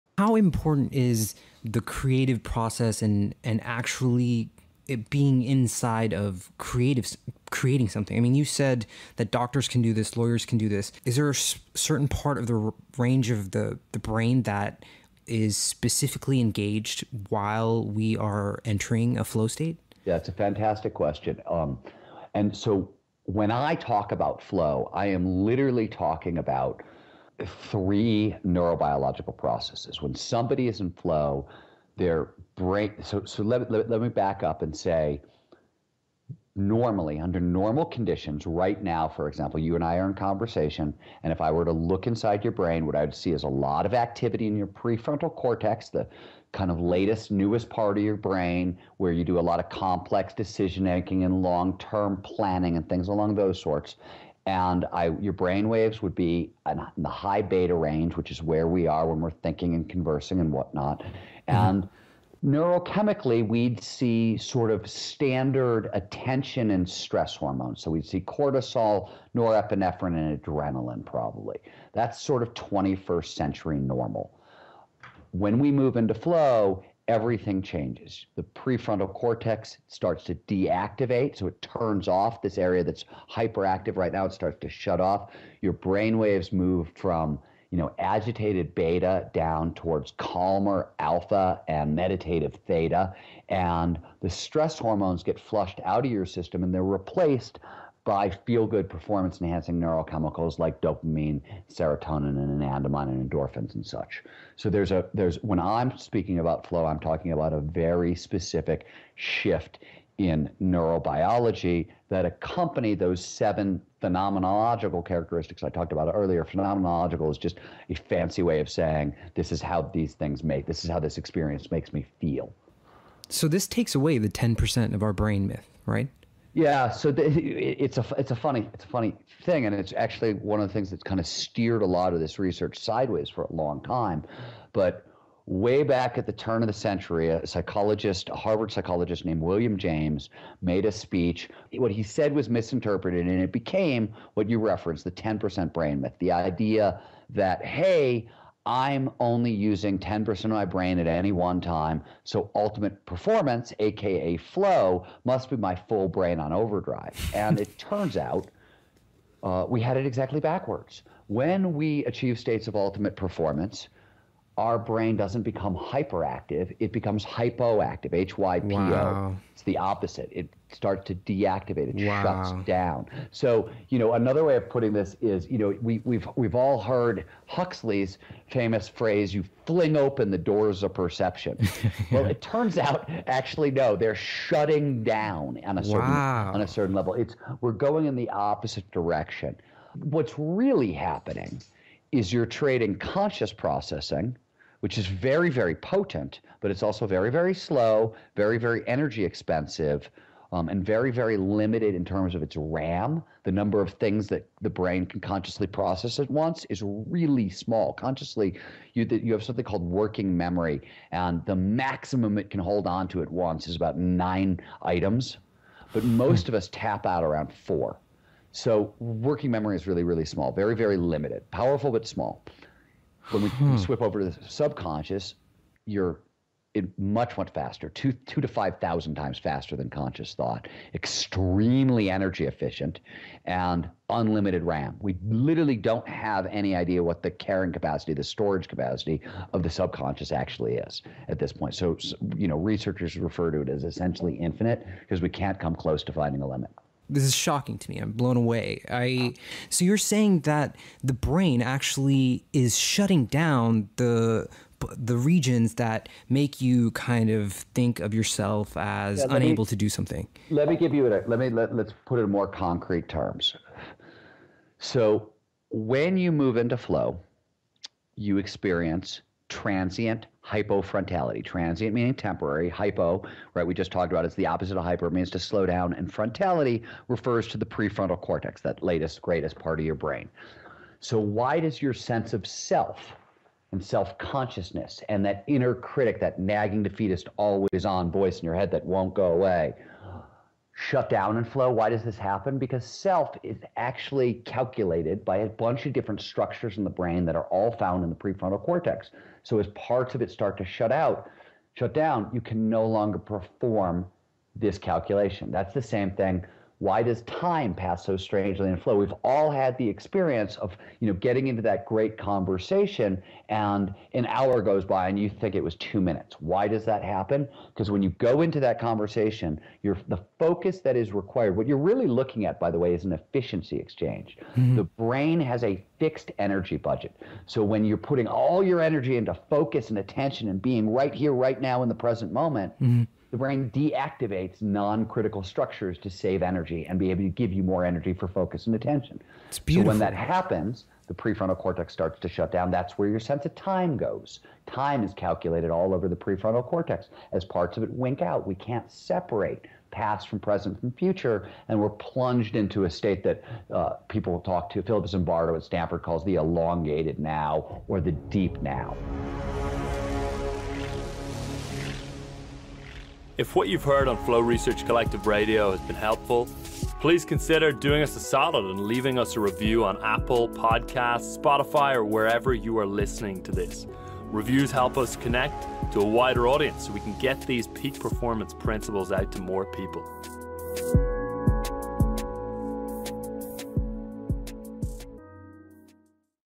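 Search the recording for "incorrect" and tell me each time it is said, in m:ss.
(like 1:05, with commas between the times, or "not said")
not said.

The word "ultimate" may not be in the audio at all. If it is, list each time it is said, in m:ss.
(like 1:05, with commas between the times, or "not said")
2:32, 2:42.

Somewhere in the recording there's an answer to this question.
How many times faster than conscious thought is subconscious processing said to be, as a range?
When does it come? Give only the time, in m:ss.
3:48.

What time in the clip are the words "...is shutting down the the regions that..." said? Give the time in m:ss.
4:12.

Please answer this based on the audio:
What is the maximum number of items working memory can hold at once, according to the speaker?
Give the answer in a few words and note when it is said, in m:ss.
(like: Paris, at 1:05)
9, at 3:33.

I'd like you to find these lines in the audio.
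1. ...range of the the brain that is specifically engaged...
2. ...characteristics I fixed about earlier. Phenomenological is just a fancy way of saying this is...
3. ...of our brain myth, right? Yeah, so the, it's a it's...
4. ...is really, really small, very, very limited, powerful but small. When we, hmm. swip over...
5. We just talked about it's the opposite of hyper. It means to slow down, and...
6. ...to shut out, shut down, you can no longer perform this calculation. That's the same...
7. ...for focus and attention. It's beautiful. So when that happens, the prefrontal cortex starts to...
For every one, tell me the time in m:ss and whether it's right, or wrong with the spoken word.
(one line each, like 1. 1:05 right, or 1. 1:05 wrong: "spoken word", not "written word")
1. 0:12 right
2. 1:55 wrong: "talked", not "fixed"
3. 2:04 right
4. 3:39 right
5. 4:33 right
6. 5:00 right
7. 5:38 right.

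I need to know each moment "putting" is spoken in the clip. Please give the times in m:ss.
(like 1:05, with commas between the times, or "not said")
2:54, 5:27.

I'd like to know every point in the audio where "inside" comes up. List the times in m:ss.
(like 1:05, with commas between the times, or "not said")
0:05, 0:42.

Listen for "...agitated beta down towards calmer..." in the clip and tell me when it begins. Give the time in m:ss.
1:27.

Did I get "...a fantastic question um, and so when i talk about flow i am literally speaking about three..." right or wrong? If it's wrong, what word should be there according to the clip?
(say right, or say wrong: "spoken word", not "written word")
wrong: "talking", not "speaking".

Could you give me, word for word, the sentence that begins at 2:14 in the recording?
But way back at the turn of the century, a psychologist, a Harvard psychologist named William James, made a speech.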